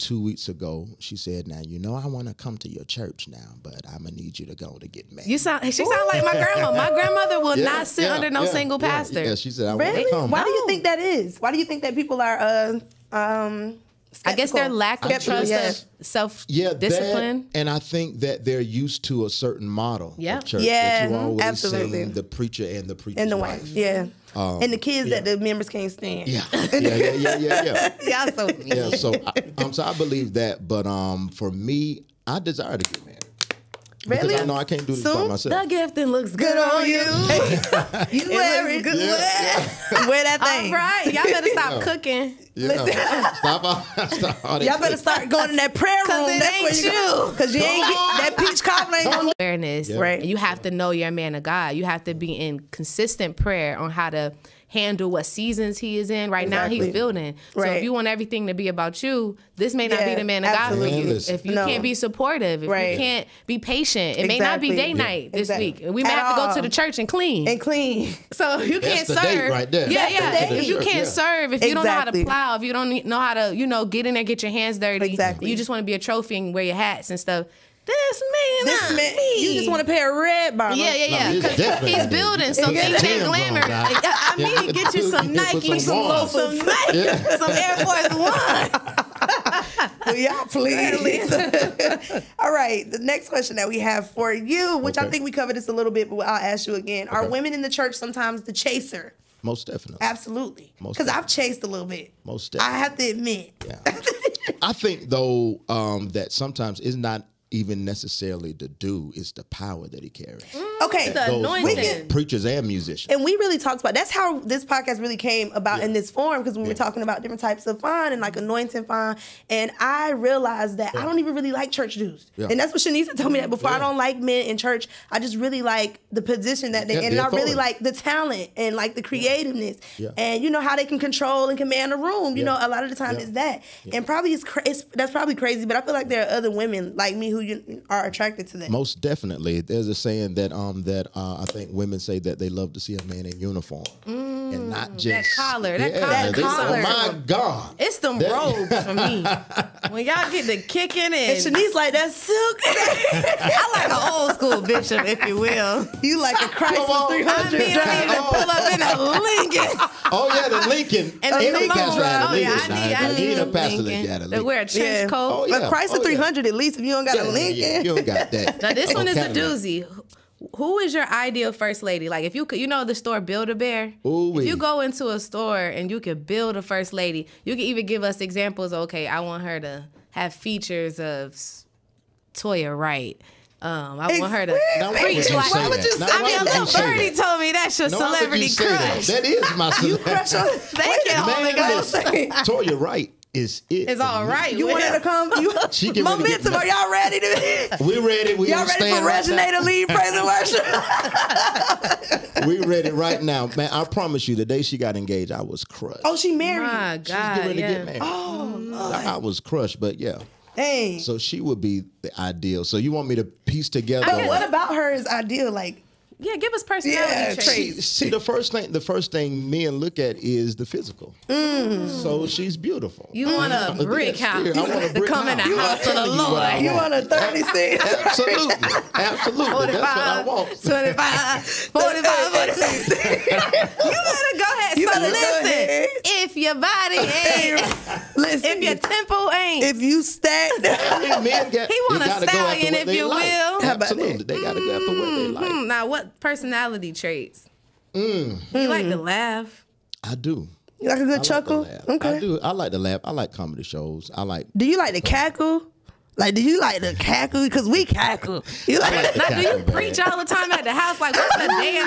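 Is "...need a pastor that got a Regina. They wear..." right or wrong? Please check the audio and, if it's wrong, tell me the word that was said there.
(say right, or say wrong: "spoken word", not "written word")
wrong: "Lincoln", not "Regina".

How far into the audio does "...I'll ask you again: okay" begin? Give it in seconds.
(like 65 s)
96 s.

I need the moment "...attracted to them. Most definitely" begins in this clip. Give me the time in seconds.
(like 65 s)
138 s.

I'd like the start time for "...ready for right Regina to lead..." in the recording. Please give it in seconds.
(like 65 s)
198 s.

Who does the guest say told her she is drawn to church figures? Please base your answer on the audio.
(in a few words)
Shanisa.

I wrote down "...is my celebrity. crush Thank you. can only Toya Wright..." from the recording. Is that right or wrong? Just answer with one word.
right.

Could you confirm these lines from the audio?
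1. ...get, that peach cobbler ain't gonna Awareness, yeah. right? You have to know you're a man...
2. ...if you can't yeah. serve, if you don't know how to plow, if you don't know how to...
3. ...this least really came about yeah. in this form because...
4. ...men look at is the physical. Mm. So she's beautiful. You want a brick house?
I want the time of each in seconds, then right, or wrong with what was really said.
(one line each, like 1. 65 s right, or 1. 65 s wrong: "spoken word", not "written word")
1. 47 s right
2. 70 s right
3. 114 s wrong: "podcast", not "least"
4. 219 s right.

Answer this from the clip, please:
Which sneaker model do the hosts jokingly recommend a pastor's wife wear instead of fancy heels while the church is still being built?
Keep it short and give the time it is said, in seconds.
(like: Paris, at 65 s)
Air Force One, at 87 s.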